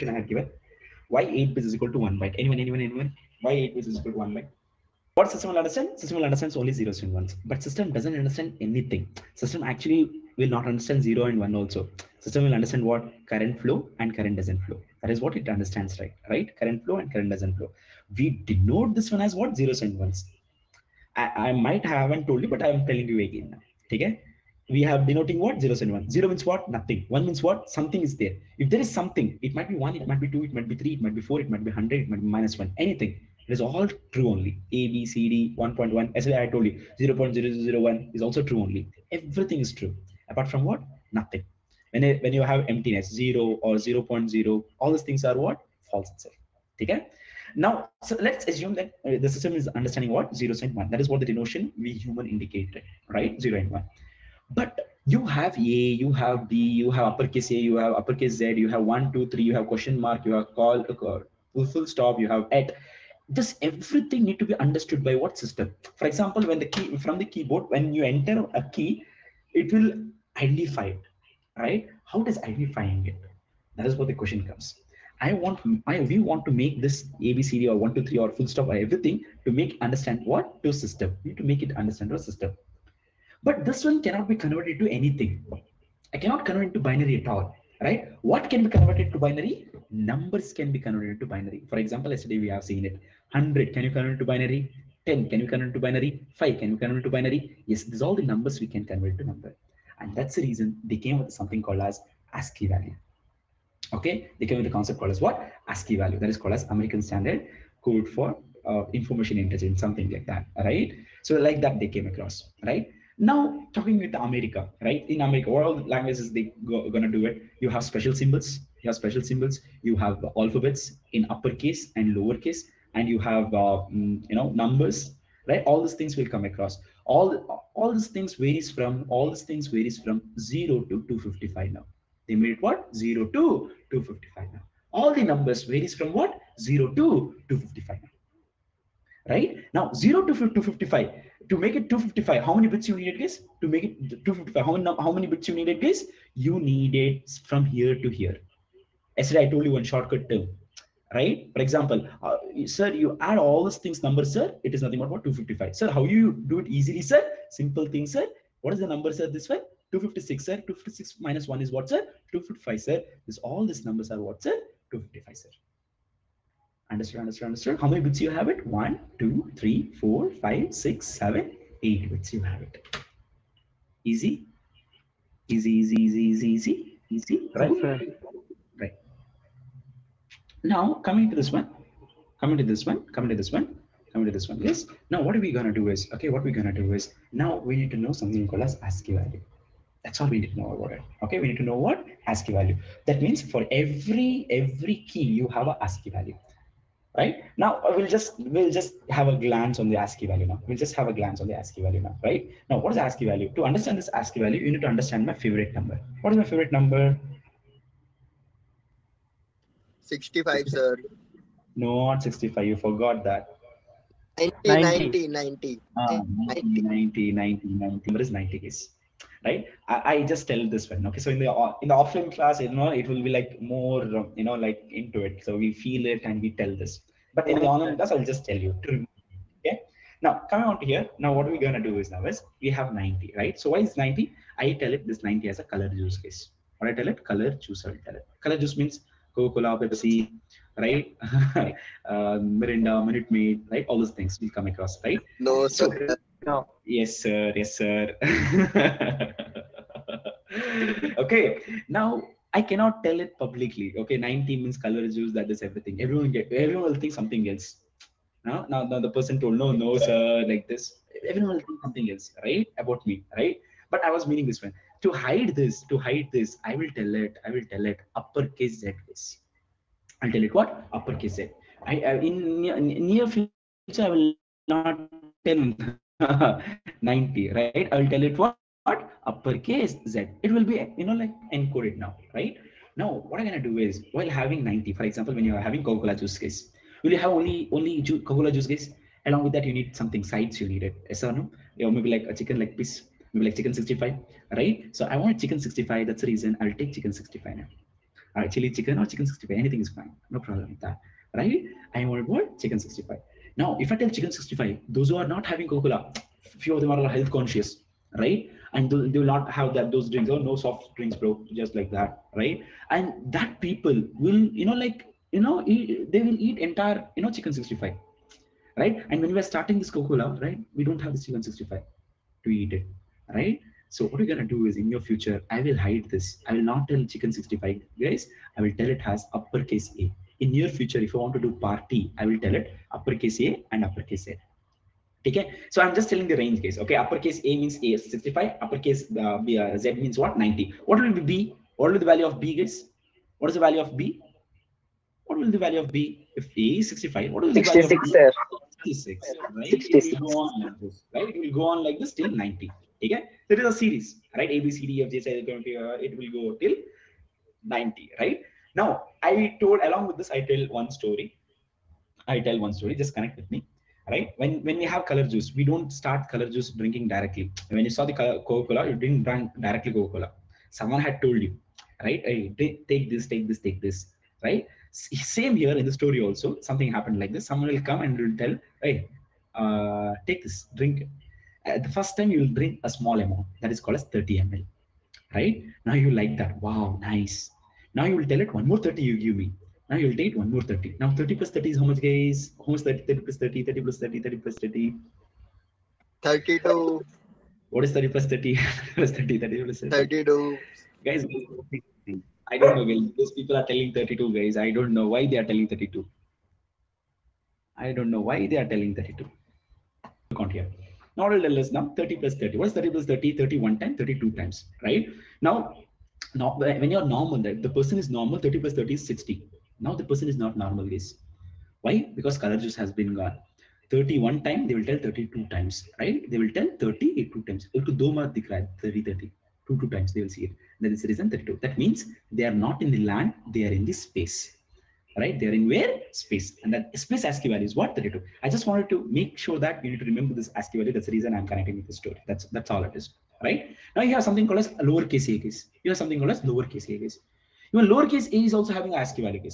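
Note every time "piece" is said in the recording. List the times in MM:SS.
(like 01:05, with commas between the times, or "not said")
04:52.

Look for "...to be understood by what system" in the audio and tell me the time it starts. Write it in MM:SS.
01:04.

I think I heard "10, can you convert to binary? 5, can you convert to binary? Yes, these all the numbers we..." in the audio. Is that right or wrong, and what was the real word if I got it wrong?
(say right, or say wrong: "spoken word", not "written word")
right.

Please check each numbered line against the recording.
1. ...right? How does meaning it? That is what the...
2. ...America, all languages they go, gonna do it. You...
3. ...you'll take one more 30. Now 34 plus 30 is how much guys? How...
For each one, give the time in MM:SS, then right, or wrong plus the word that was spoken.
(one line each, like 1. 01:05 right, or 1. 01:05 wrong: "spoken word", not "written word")
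1. 01:11 wrong: "identifying", not "meaning"
2. 01:55 right
3. 06:29 wrong: "30", not "34".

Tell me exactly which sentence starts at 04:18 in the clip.
Now, now, now the person told no, no, sir, like this.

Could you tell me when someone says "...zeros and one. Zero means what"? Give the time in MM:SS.
00:25.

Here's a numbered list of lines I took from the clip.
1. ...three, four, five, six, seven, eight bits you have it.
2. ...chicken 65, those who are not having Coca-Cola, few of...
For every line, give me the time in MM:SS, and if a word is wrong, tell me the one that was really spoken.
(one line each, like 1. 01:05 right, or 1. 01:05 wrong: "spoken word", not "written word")
1. 02:49 right
2. 05:04 right.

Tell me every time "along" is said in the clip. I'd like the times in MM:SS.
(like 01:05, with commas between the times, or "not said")
04:49, 05:59.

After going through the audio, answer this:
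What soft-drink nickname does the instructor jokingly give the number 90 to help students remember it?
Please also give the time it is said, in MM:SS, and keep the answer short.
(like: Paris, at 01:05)
color juice case, at 03:55.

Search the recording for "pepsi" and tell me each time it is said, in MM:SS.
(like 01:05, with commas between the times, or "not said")
03:59.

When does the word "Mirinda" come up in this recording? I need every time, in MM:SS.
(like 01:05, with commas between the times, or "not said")
04:02.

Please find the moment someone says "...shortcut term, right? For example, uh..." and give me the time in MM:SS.
02:29.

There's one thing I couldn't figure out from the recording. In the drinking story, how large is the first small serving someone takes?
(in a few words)
30 ml.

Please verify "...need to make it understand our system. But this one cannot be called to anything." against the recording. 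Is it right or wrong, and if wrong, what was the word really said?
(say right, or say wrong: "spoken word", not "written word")
wrong: "converted", not "called".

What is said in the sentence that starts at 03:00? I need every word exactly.
Now, coming to this one, coming to this one, coming to this one, coming to this one.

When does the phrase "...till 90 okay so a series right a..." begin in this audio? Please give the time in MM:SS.
05:52.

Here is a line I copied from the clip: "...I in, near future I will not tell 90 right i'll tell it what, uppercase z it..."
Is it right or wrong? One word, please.
right.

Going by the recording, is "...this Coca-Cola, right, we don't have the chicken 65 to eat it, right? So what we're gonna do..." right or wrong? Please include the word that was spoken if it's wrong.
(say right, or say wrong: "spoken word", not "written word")
right.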